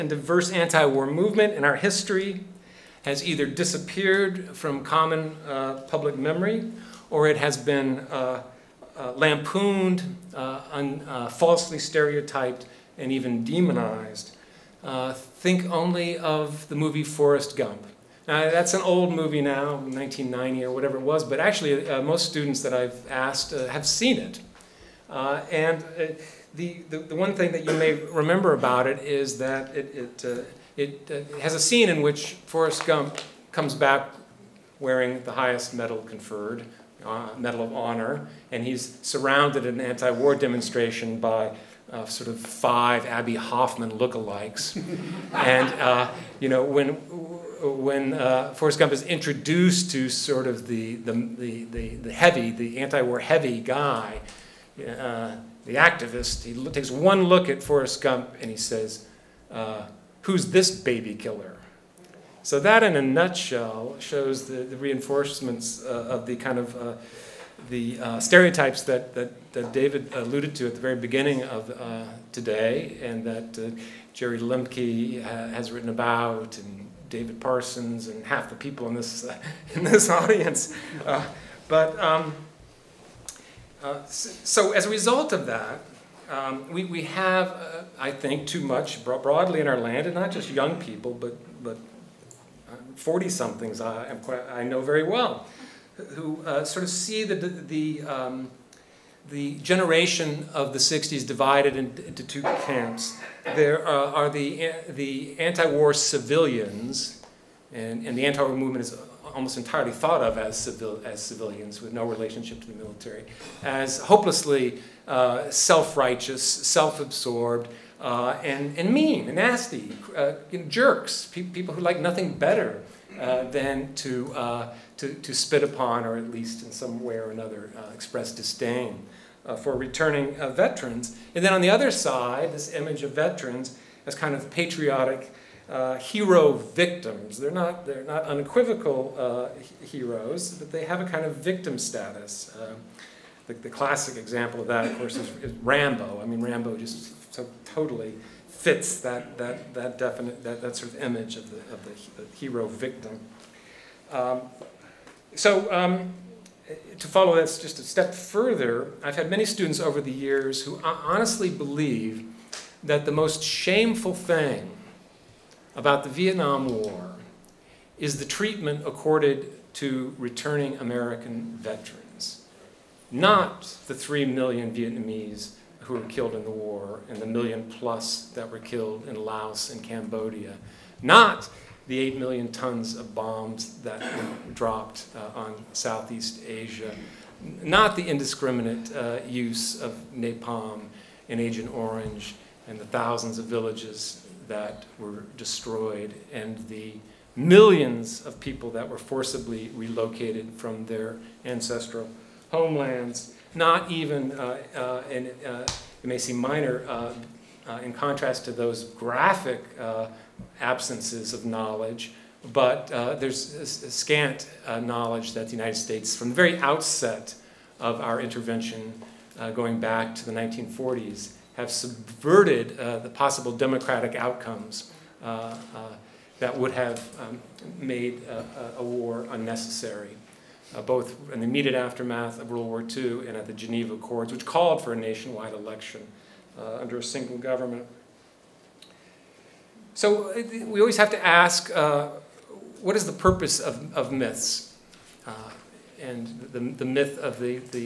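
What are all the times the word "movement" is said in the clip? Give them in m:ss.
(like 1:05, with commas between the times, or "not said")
0:01, 1:48.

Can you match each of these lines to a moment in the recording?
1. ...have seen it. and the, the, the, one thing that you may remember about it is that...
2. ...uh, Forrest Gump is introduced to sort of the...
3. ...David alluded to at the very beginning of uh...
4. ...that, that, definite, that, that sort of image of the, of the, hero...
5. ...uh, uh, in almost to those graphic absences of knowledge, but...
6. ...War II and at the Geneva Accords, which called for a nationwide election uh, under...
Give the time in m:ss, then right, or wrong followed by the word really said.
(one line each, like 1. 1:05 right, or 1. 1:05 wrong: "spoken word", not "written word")
1. 0:23 right
2. 0:48 right
3. 1:09 right
4. 2:29 right
5. 3:26 wrong: "contrast", not "almost"
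6. 3:52 right.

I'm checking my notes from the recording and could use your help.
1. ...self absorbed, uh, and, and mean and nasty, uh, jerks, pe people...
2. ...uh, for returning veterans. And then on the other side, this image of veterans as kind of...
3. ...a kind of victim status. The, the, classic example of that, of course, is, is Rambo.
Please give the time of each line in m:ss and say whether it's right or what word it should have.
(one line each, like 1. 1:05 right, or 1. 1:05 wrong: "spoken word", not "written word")
1. 1:56 right
2. 2:09 right
3. 2:20 right.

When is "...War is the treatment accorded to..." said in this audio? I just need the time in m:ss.
2:46.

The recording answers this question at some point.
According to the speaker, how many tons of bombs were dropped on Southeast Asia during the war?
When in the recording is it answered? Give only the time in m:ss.
3:01.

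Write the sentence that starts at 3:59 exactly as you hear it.
So uh, we always have to ask, uh, what is the purpose of, of myths?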